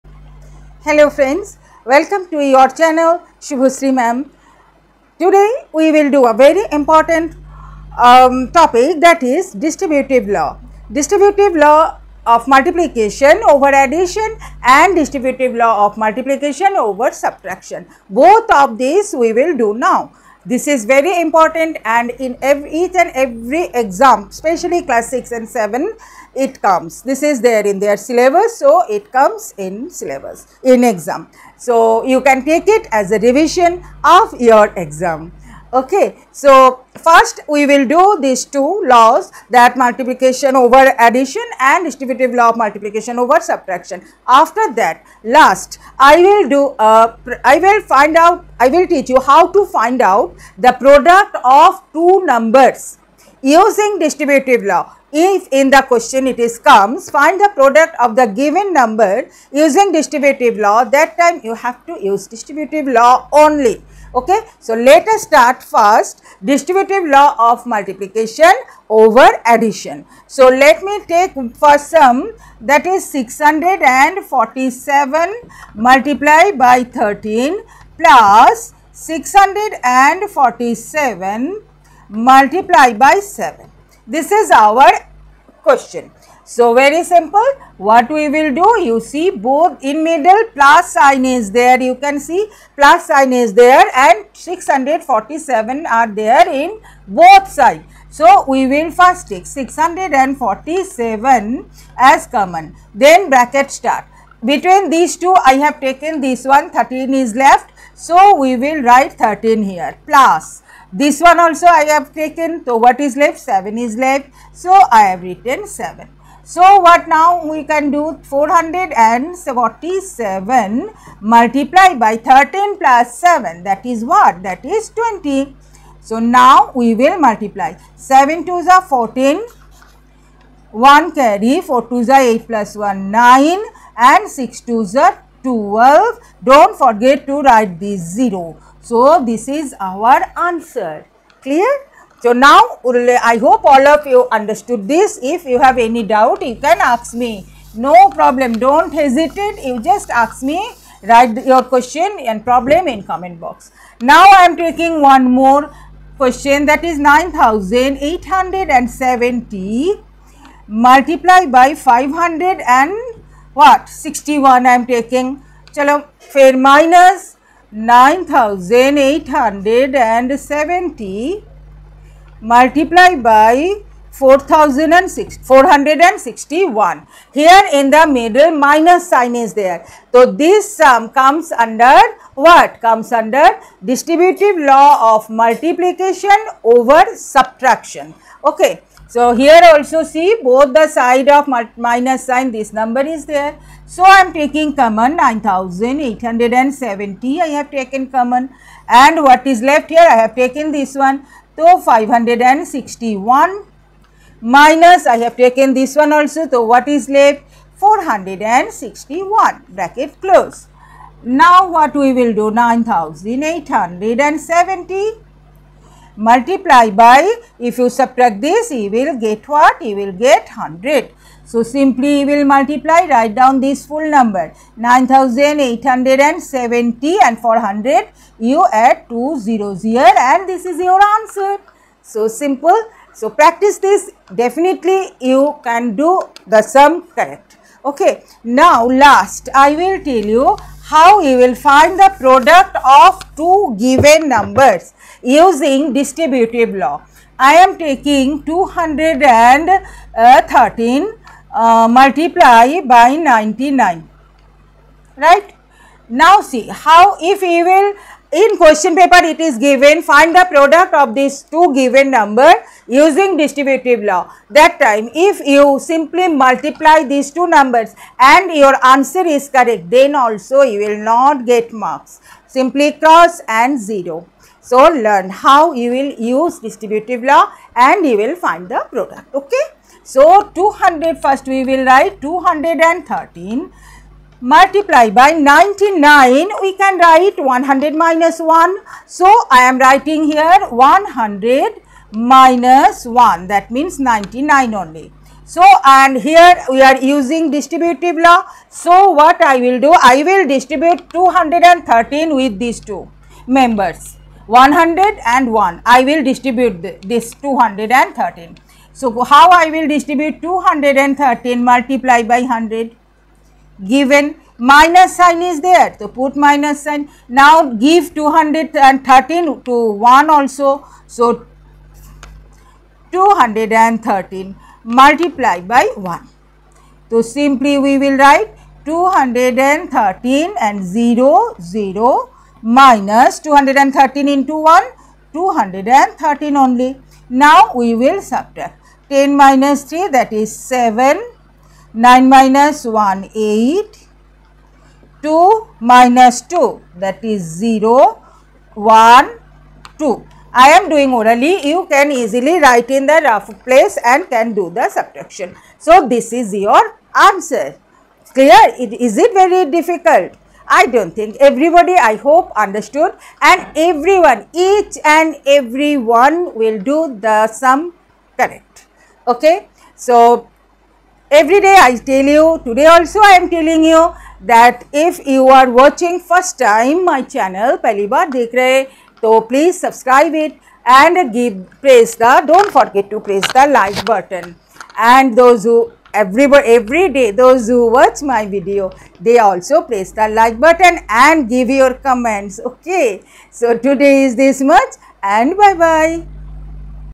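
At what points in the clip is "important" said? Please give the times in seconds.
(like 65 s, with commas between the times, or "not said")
6 s, 21 s.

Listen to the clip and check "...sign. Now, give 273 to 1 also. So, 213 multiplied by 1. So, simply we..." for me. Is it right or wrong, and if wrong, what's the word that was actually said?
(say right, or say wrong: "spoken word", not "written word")
wrong: "213", not "273".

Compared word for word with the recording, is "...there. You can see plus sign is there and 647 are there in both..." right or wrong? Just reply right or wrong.
right.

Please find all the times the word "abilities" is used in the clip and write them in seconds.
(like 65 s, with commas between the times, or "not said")
not said.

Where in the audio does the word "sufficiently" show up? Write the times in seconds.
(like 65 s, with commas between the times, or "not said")
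not said.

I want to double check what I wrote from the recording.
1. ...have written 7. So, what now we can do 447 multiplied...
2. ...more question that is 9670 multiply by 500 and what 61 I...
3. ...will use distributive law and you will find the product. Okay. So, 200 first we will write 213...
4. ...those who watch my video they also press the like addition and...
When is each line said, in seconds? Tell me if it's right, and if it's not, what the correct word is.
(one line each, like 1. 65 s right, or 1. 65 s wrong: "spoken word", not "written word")
1. 115 s right
2. 155 s wrong: "9870", not "9670"
3. 275 s right
4. 387 s wrong: "button", not "addition".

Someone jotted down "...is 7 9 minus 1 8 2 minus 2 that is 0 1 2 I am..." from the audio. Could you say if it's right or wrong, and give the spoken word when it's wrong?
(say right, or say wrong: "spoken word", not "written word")
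right.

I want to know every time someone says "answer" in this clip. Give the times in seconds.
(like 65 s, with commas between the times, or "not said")
140 s, 231 s, 268 s, 357 s.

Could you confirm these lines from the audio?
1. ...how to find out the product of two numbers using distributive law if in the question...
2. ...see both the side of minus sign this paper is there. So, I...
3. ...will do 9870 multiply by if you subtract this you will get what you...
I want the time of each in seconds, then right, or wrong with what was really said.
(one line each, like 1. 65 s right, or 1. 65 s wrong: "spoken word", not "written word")
1. 49 s right
2. 190 s wrong: "number", not "paper"
3. 212 s right.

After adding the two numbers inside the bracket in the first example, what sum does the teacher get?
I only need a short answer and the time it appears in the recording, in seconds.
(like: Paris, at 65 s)
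20, at 124 s.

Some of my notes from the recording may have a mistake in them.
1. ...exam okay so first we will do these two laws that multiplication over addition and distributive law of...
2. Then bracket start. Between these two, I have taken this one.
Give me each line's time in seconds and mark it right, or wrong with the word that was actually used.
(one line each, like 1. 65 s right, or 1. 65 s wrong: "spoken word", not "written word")
1. 34 s right
2. 102 s right.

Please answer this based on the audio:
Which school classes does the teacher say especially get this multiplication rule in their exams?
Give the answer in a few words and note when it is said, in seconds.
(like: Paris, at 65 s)
class 6 and 7, at 24 s.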